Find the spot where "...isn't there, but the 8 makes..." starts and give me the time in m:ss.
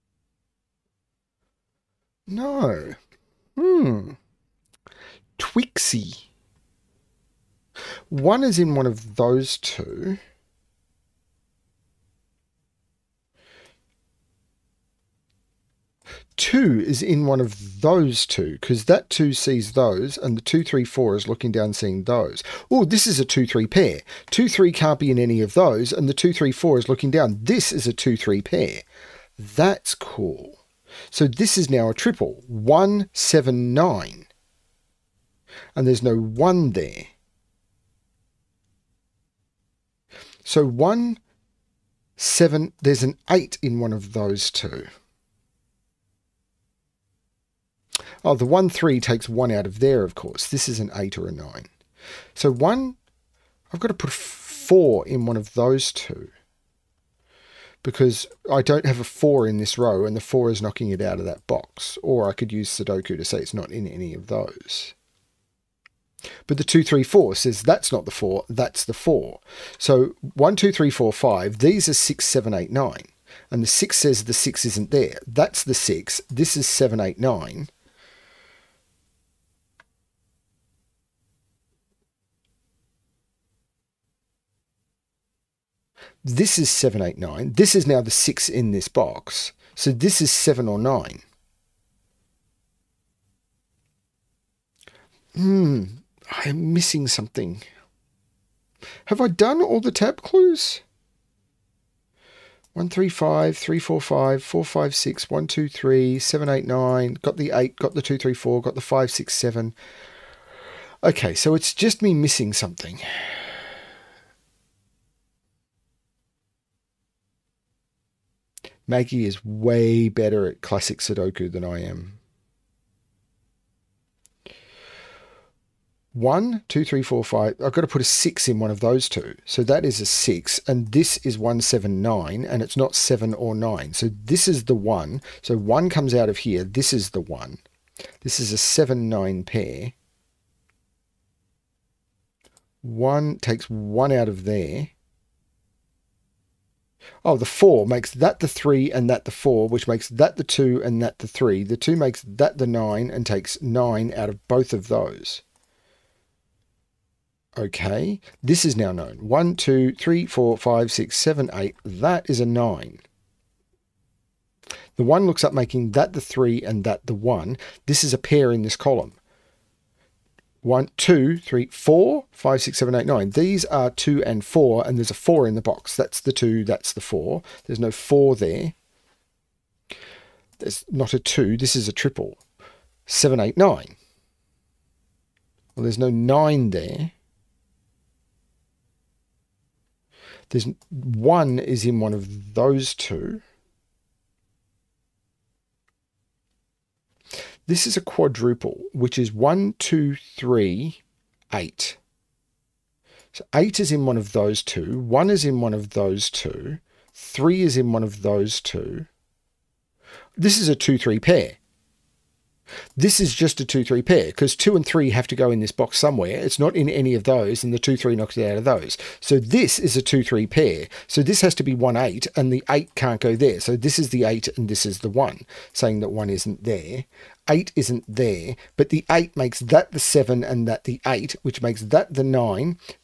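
3:47.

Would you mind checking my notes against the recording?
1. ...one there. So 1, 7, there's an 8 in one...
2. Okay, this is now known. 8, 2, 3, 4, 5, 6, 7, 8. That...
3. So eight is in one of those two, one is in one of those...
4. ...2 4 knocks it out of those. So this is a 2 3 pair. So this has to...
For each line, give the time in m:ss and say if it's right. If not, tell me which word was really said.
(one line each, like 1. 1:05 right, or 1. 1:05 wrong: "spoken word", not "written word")
1. 0:36 right
2. 2:37 wrong: "1", not "8"
3. 3:23 right
4. 3:37 wrong: "3", not "4".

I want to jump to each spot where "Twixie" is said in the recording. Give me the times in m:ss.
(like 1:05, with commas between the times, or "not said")
0:05.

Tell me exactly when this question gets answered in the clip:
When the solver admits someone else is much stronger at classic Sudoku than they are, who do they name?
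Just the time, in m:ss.
1:58.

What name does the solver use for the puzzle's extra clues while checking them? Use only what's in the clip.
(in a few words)
tab clues.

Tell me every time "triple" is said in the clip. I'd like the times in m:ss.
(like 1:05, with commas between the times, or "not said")
0:31, 3:01.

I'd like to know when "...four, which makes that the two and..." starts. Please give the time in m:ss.
2:29.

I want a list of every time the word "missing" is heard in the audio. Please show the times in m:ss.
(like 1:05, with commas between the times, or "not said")
1:36, 1:52.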